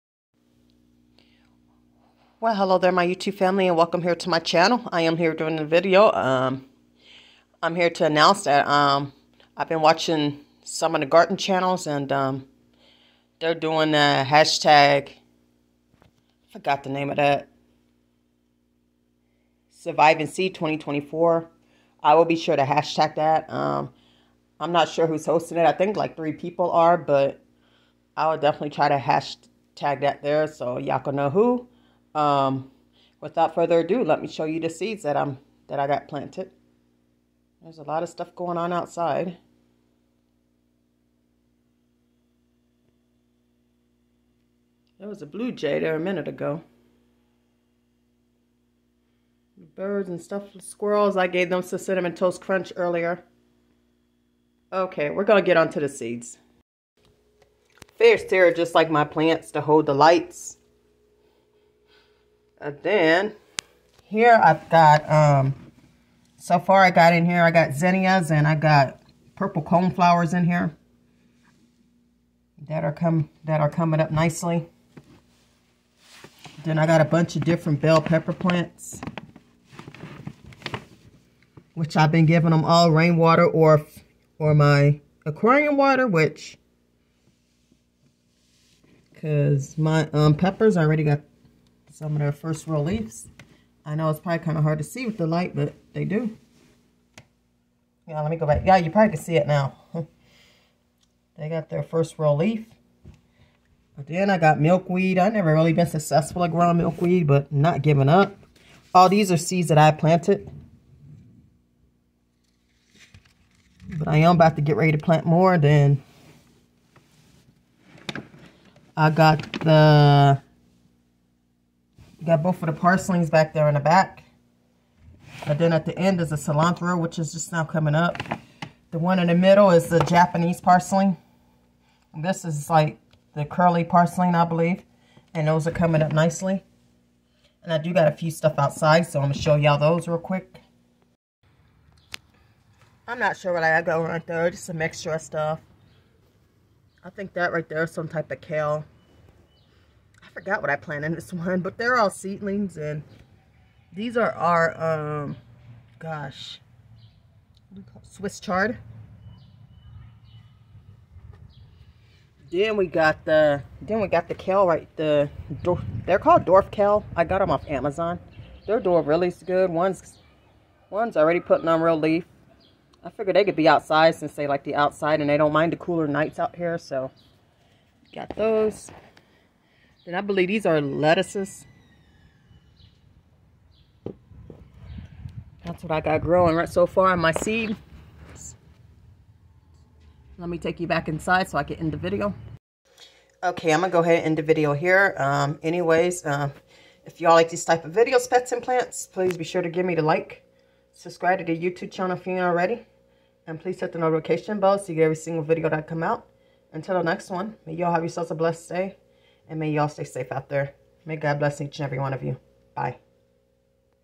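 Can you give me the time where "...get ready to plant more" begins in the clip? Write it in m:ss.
1:54.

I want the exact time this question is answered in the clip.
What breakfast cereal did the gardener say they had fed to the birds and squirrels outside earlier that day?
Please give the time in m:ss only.
0:51.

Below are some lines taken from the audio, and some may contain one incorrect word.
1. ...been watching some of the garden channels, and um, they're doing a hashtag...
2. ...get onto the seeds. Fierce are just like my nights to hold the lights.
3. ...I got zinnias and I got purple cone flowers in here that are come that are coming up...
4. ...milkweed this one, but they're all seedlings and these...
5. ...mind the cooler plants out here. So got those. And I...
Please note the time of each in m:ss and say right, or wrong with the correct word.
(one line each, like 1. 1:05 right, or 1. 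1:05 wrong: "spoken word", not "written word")
1. 0:09 right
2. 0:55 wrong: "plants", not "nights"
3. 1:07 right
4. 2:30 wrong: "planted", not "milkweed"
5. 2:55 wrong: "nights", not "plants".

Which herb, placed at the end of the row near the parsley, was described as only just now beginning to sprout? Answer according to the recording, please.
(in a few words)
cilantro.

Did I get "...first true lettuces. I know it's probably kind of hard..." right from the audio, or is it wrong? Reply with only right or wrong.
wrong.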